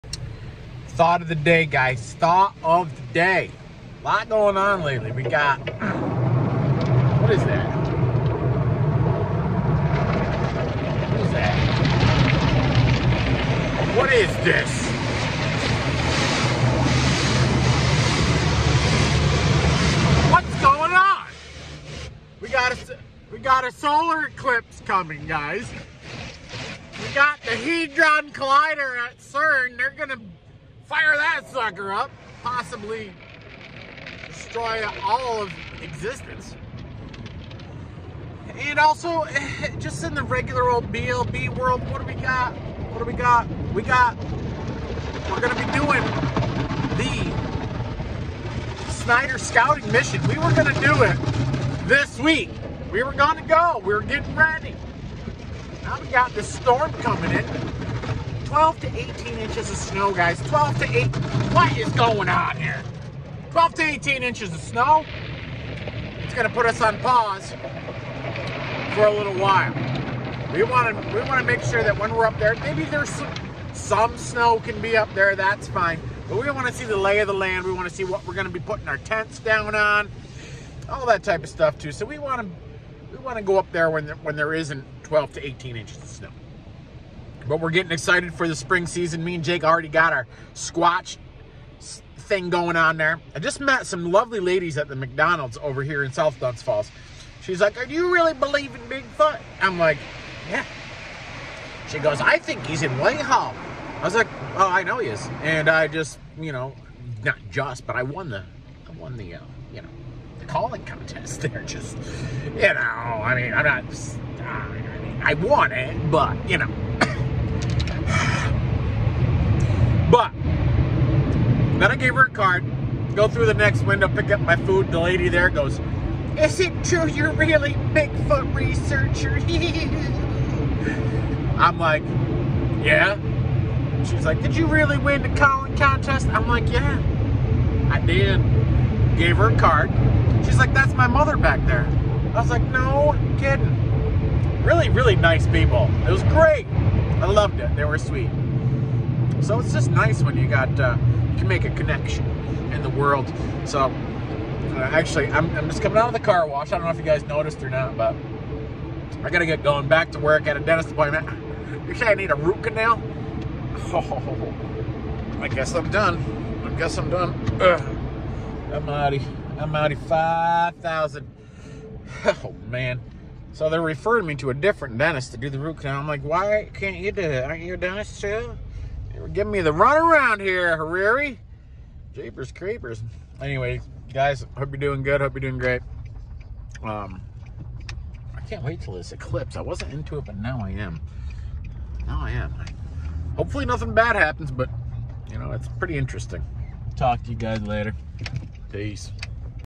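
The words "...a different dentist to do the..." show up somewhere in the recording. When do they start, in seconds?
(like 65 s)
174 s.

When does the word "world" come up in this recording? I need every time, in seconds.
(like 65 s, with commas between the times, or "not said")
41 s, 152 s.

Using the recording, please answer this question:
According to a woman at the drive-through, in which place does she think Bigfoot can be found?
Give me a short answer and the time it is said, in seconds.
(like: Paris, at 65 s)
Whitehall, at 102 s.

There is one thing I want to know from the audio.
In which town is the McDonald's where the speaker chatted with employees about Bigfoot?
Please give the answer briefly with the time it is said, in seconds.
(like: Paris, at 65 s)
South Glens Falls, at 96 s.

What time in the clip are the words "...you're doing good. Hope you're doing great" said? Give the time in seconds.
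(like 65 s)
184 s.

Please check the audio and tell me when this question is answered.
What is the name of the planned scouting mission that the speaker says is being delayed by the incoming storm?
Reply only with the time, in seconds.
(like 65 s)
48 s.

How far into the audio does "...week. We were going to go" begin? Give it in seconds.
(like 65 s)
52 s.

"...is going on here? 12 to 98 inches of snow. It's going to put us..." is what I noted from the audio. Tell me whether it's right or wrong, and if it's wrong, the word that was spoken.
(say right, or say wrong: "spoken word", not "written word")
wrong: "18", not "98".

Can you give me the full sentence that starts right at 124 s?
The lady there goes, Is it true you're really Bigfoot researcher?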